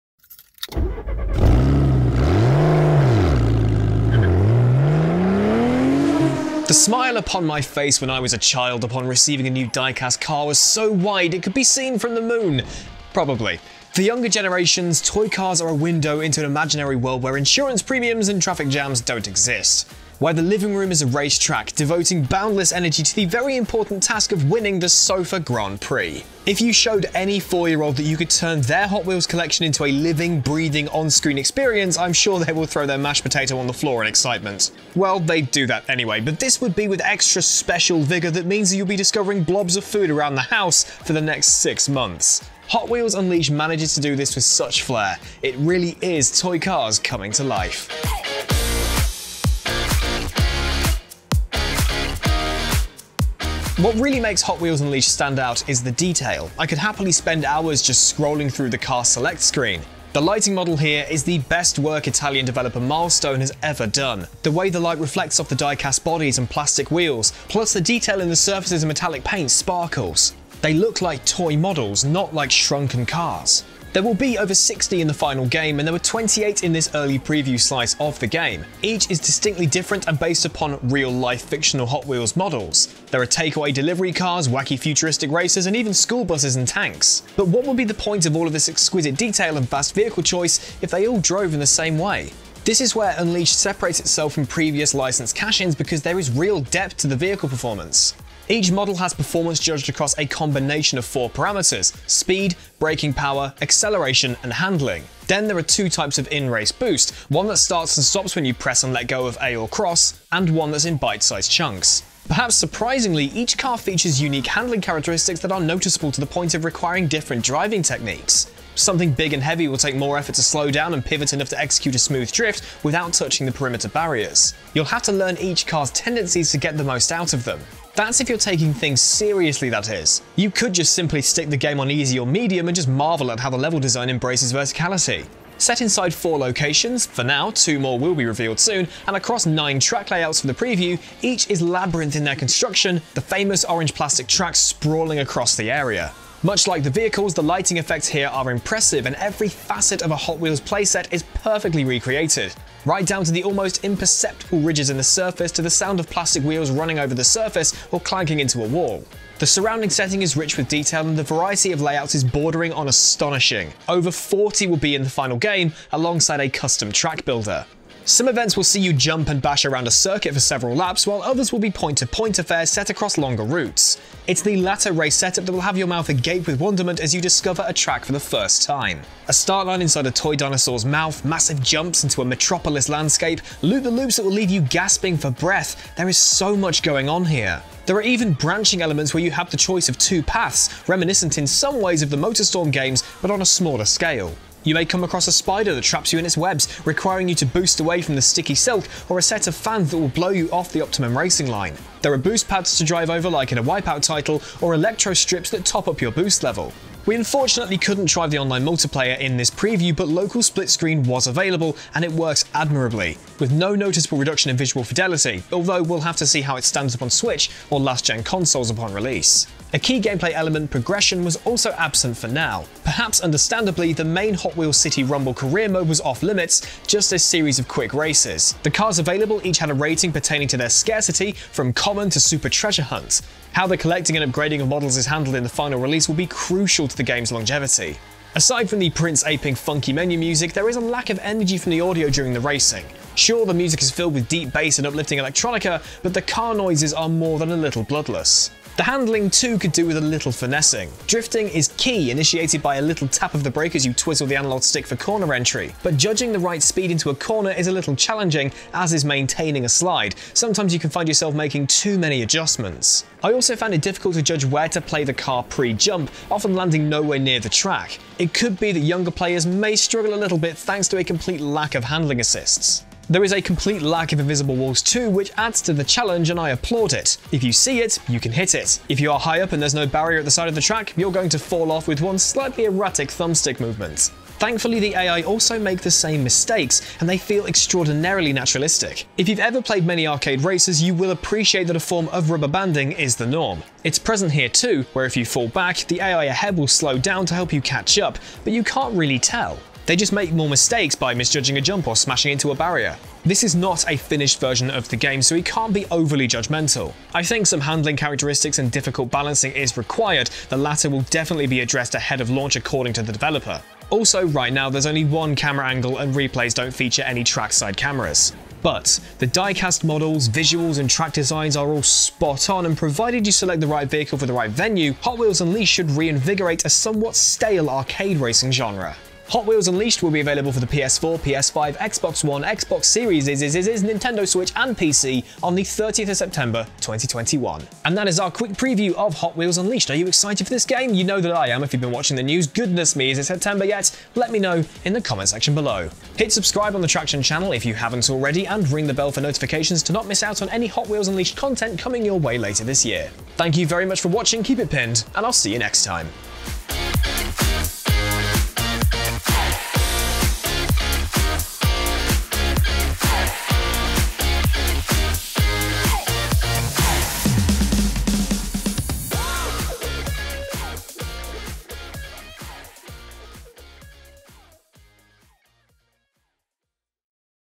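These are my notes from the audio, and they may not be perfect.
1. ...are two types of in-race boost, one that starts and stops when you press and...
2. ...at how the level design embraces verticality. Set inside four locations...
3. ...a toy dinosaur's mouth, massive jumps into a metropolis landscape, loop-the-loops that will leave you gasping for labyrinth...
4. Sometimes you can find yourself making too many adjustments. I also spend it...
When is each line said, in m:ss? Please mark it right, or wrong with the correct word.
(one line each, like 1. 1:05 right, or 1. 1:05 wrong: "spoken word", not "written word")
1. 1:45 right
2. 2:13 right
3. 3:00 wrong: "breath", not "labyrinth"
4. 4:20 wrong: "found", not "spend".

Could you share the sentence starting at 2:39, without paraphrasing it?
The surrounding setting is rich with detail and the variety of layouts is bordering on astonishing.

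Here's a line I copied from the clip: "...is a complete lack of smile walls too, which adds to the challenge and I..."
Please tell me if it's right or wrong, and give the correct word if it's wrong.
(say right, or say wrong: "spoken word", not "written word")
wrong: "invisible", not "smile".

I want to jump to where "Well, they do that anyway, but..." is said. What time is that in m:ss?
0:34.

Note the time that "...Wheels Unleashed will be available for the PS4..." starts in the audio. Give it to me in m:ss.
5:29.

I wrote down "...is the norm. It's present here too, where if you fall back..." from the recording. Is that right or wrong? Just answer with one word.
right.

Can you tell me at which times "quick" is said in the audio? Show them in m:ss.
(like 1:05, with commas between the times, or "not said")
3:47, 5:38.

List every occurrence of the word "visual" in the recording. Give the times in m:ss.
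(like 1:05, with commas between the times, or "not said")
3:34, 5:20.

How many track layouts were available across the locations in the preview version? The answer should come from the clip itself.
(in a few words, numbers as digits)
9.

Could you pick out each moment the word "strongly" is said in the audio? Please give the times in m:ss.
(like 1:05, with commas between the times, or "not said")
not said.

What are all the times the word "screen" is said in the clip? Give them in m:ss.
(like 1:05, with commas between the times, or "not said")
0:30, 0:59, 3:30.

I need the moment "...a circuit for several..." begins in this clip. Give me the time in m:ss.
2:49.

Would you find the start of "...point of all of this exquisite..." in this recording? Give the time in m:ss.
1:27.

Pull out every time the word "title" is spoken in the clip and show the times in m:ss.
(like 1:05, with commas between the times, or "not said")
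3:24.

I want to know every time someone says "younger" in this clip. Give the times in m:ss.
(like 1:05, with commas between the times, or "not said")
0:14, 4:28.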